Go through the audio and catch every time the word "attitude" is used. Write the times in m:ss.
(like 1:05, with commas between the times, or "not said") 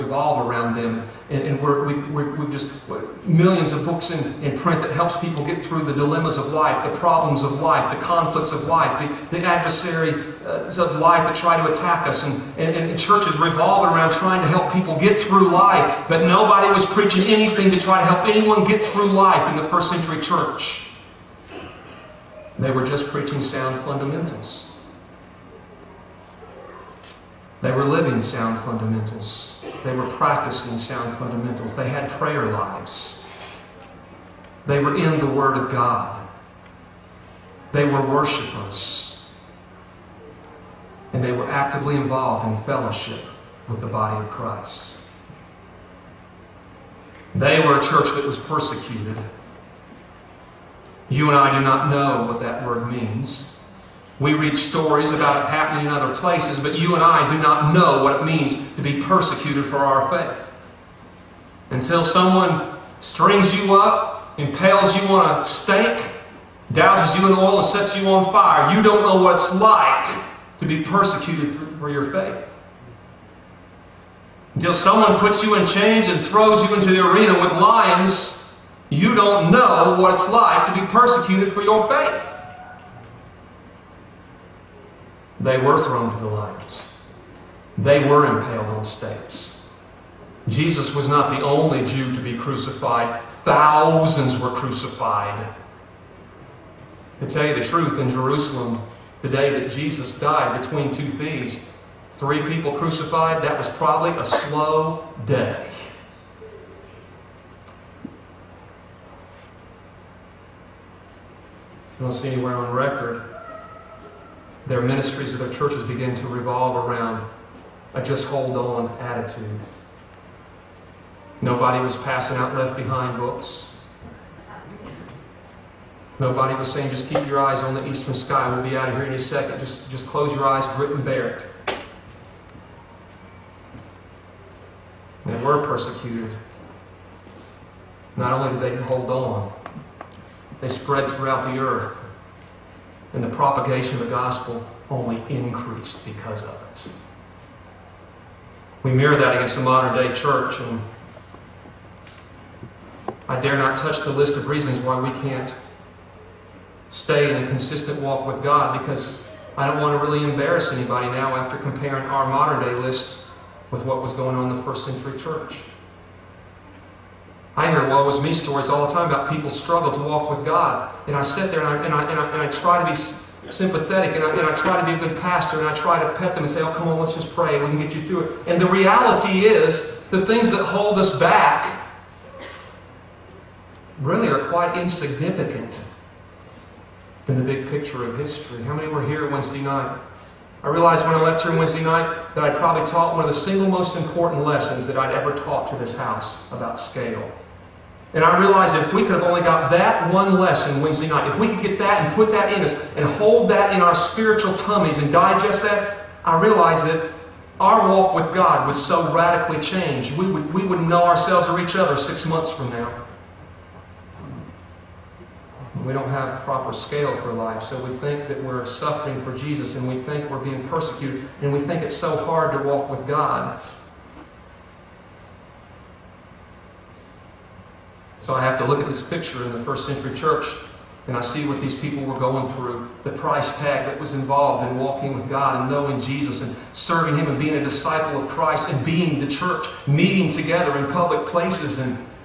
1:58.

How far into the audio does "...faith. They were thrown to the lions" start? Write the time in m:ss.
1:21.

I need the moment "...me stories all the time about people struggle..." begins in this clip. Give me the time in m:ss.
2:48.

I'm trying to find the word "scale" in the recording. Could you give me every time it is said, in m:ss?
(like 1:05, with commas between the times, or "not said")
3:16, 3:36.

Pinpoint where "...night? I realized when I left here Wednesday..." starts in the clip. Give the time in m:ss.
3:09.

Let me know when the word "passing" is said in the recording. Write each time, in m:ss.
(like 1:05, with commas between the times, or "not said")
2:01.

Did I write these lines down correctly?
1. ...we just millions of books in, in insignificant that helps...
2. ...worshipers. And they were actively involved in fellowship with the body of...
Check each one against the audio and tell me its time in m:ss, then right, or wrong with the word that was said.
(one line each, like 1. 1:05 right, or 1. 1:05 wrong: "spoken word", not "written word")
1. 0:02 wrong: "print", not "insignificant"
2. 0:38 right.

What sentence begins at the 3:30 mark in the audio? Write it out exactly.
We would, we would know ourselves or each other six months from now.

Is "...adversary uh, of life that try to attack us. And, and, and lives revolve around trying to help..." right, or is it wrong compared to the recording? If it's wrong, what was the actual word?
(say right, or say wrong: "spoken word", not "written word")
wrong: "churches", not "lives".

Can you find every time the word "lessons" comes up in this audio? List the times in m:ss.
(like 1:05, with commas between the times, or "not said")
3:14, 3:20.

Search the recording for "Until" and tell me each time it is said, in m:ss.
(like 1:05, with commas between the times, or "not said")
1:01, 1:14.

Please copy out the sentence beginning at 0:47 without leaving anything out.
They were a church that was persecuted.